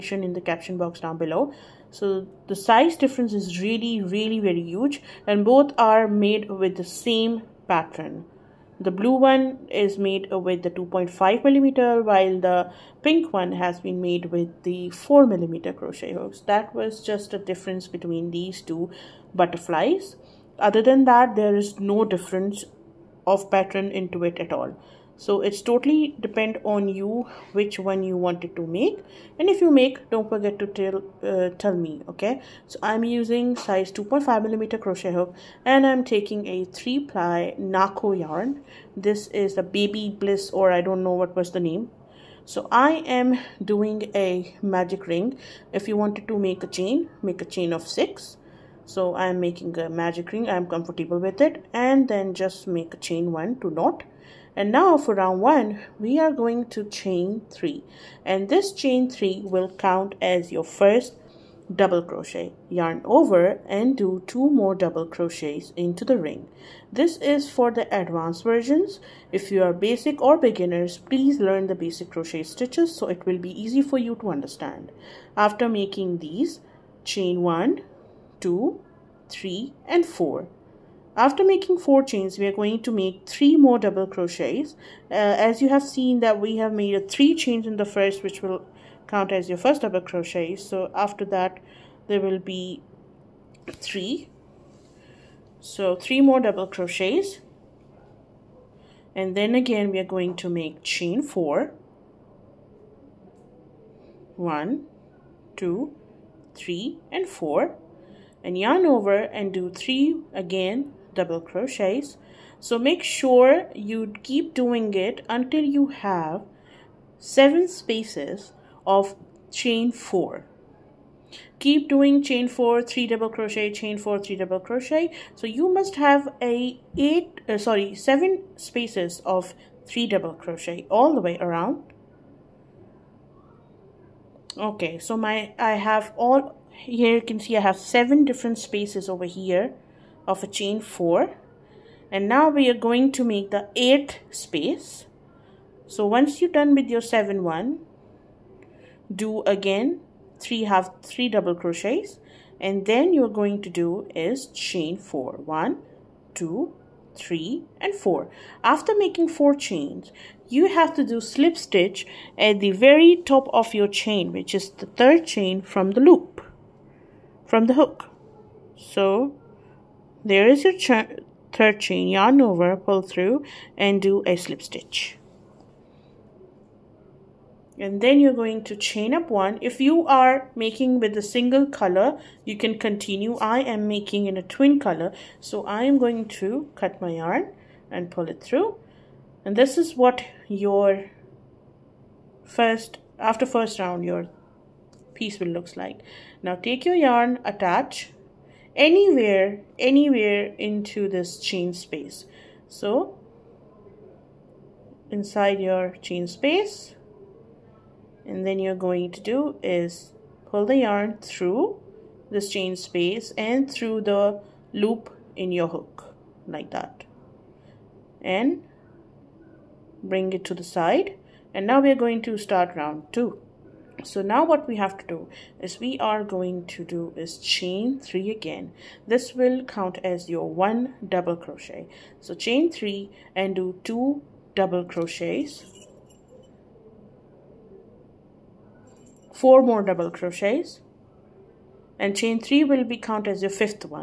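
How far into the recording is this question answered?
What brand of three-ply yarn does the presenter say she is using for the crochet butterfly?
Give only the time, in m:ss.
0:37.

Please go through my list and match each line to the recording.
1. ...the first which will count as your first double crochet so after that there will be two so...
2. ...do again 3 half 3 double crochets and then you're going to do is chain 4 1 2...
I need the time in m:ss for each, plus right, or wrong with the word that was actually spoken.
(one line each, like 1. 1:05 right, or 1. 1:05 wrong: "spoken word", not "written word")
1. 1:27 wrong: "three", not "two"
2. 2:29 right.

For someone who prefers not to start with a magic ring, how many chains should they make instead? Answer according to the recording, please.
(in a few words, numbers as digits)
6.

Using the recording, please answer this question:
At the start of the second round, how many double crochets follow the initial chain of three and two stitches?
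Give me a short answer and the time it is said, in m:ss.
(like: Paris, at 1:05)
4, at 3:59.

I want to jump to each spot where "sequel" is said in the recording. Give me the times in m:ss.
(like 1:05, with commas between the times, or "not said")
not said.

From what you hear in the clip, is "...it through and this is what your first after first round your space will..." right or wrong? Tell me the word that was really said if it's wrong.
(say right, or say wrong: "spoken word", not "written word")
wrong: "piece", not "space".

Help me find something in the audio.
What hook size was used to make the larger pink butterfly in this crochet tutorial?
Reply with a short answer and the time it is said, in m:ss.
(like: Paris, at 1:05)
4 millimeter, at 0:14.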